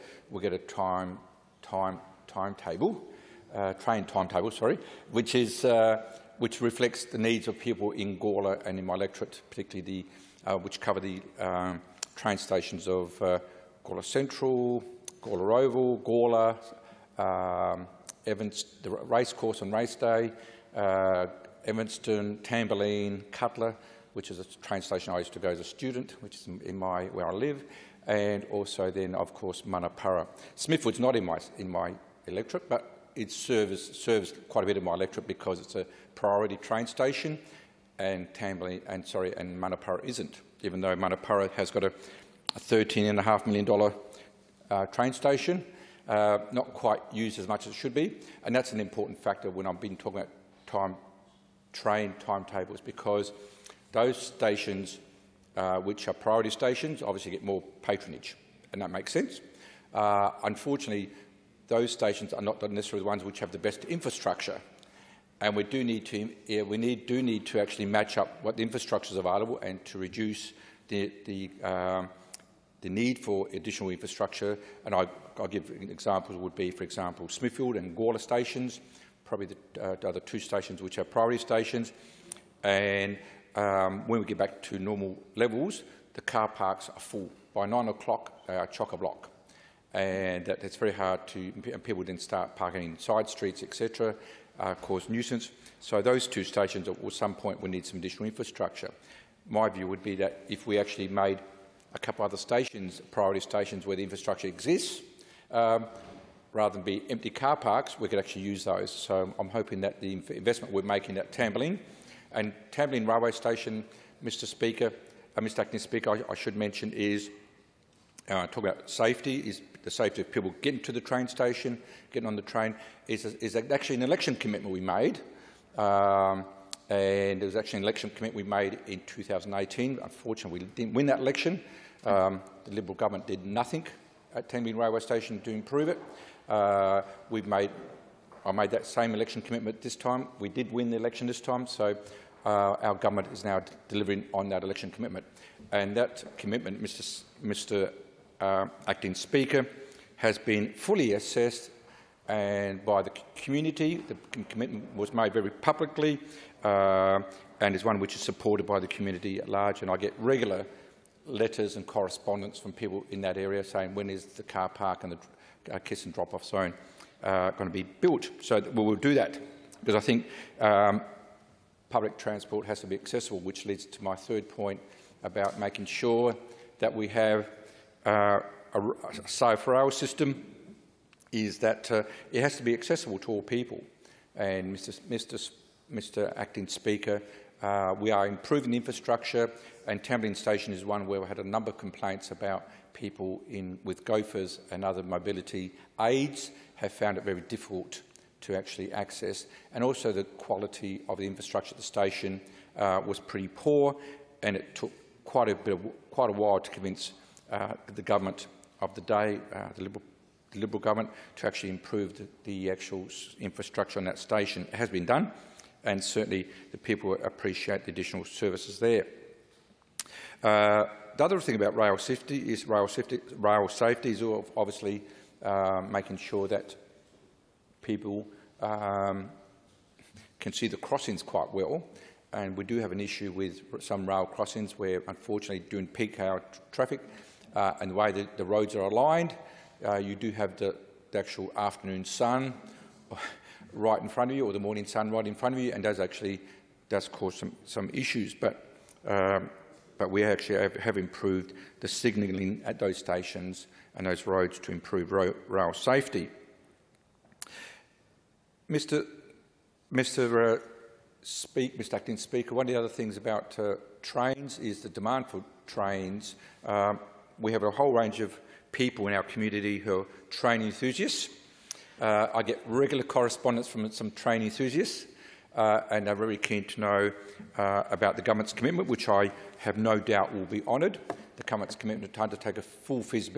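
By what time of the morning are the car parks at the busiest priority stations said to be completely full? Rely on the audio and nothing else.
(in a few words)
9 o'clock.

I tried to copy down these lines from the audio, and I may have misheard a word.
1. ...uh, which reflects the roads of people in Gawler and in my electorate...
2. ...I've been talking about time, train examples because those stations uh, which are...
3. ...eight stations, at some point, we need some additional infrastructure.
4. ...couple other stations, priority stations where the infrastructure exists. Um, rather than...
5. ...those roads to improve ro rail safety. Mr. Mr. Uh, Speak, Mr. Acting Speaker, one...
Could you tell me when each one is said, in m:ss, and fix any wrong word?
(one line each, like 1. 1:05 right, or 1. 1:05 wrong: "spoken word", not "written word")
1. 0:05 wrong: "needs", not "roads"
2. 0:49 wrong: "timetables", not "examples"
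3. 1:36 wrong: "two", not "eight"
4. 1:41 right
5. 4:14 right.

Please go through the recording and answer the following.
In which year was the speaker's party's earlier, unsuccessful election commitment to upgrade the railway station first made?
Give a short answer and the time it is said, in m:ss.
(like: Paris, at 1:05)
2018, at 2:09.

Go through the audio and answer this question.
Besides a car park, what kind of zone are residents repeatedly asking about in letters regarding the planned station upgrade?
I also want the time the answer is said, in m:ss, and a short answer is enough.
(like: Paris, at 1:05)
Kiss and drop-off zone, at 2:45.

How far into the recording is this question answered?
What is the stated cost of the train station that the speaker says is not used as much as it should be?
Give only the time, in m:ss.
0:42.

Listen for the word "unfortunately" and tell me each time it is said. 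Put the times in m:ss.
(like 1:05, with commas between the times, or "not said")
1:00, 2:10, 3:55.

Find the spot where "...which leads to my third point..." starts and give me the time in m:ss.
2:53.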